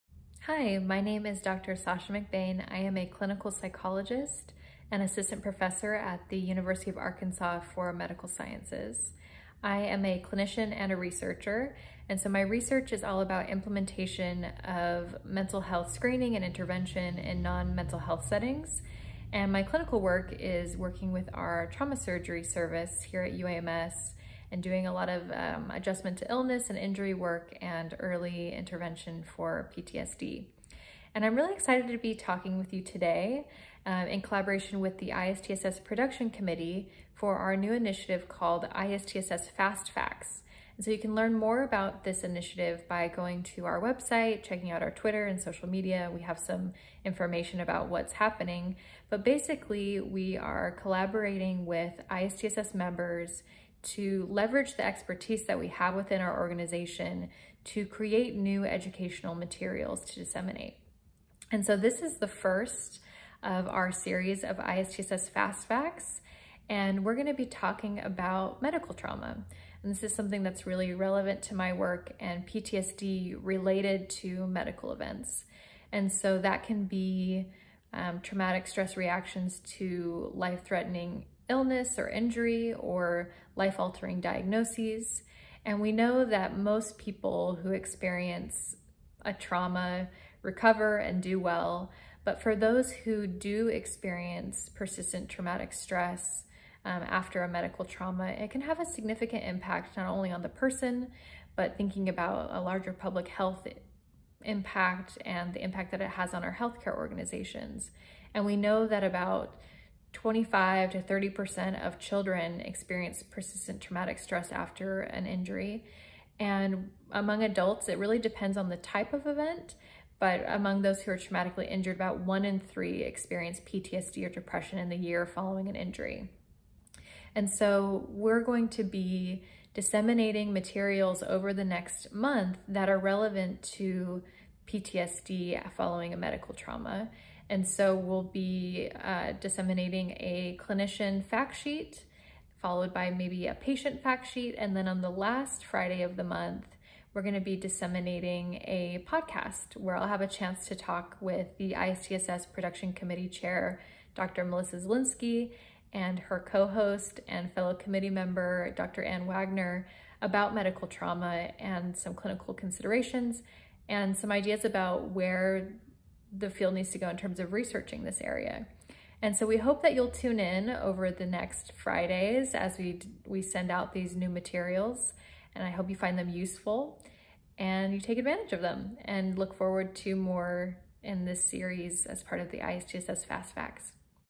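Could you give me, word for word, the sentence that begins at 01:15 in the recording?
And so that can be um, traumatic stress reactions to life-threatening illness or injury or life-altering diagnoses.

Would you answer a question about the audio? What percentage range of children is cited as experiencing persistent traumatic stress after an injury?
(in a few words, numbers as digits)
25 to 30%.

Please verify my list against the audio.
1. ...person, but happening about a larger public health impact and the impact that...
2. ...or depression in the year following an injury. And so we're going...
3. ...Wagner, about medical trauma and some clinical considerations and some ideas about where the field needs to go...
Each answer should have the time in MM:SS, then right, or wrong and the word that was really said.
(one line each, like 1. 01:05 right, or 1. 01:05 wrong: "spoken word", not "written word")
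1. 01:40 wrong: "thinking", not "happening"
2. 02:04 right
3. 02:39 right.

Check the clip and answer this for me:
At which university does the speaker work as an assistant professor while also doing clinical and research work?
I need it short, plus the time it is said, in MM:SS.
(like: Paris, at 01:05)
University of Arkansas for Medical Sciences, at 00:06.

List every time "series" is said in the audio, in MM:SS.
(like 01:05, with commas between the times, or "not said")
01:03, 03:01.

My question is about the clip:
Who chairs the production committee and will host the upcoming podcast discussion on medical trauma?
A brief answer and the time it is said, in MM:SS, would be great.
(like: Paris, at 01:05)
Dr. Melissa Zielinski, at 02:34.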